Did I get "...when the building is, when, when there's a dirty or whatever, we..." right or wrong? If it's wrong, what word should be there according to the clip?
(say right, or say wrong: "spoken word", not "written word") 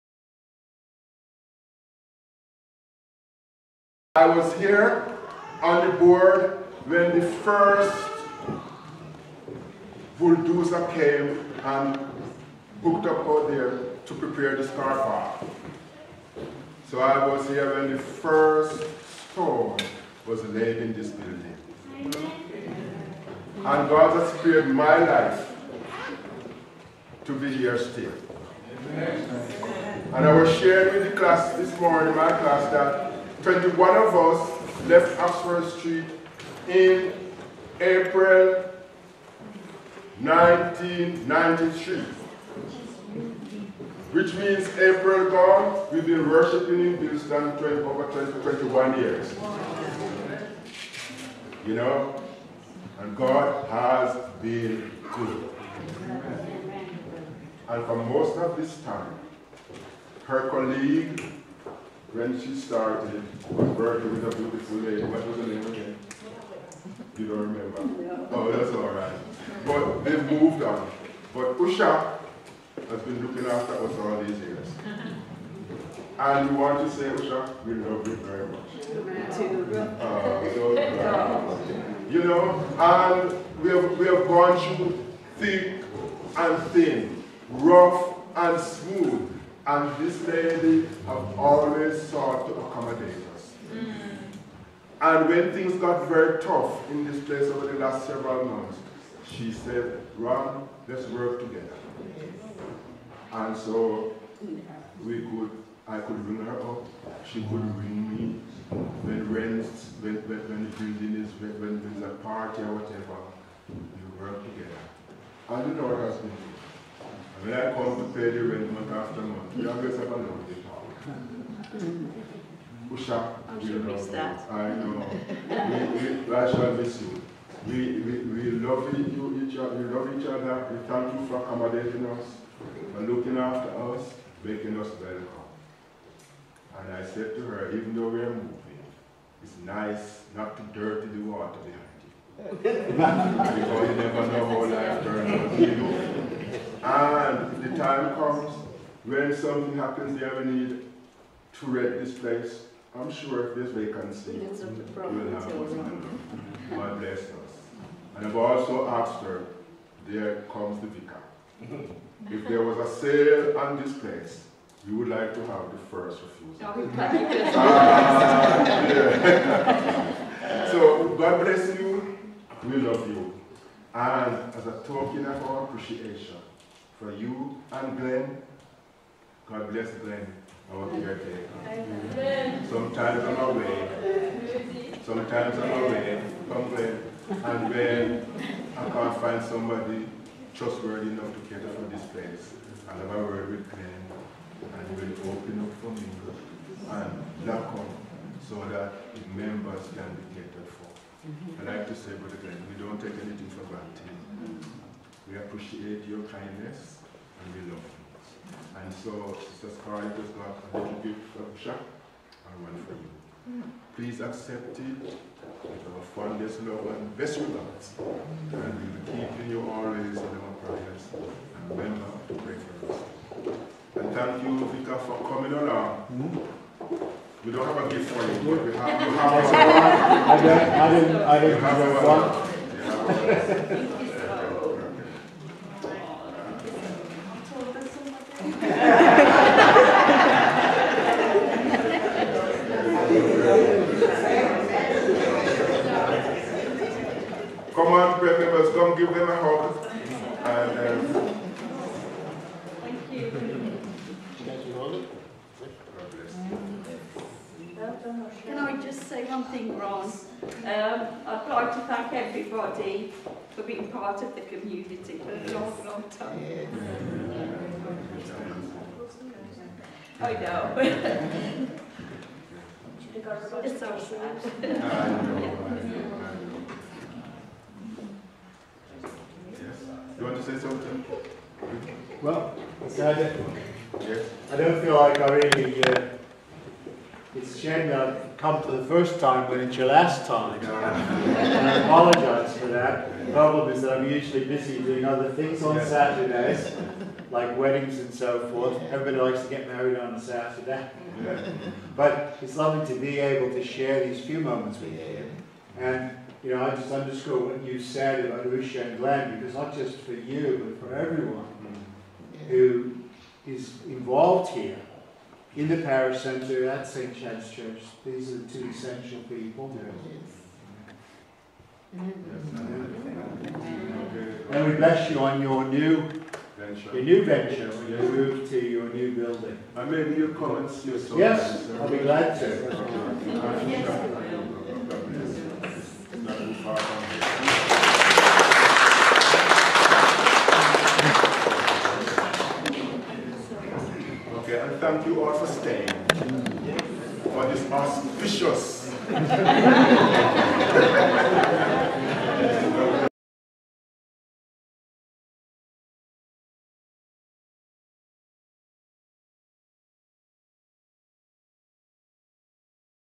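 wrong: "party", not "dirty".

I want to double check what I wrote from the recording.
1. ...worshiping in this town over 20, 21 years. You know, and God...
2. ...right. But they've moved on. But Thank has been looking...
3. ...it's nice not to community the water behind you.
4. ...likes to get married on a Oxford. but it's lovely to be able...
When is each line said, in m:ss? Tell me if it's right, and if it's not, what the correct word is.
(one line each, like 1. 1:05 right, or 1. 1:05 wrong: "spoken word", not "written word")
1. 0:46 right
2. 1:08 wrong: "Usha", not "Thank"
3. 2:19 wrong: "dirty", not "community"
4. 4:59 wrong: "Saturday", not "Oxford".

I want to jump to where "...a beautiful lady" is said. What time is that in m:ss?
1:04.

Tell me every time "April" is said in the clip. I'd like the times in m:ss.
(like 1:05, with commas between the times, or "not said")
0:37, 0:44.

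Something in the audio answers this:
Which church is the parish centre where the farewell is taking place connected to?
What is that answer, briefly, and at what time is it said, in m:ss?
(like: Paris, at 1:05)
St. Chad's Church, at 5:16.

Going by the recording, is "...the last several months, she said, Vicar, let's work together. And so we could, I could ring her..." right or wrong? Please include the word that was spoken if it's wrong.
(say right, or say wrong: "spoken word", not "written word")
wrong: "Ron", not "Vicar".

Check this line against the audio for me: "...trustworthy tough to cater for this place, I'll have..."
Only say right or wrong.
wrong.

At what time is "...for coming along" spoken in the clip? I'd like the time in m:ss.
3:44.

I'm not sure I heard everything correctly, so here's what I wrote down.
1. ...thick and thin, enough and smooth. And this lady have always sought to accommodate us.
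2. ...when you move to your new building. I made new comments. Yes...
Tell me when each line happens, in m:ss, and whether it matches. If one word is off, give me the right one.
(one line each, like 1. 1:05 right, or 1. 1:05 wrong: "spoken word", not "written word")
1. 1:25 wrong: "rough", not "enough"
2. 5:27 right.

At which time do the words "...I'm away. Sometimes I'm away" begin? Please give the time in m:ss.
3:03.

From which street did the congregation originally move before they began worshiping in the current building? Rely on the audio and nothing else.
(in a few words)
Oxford Street.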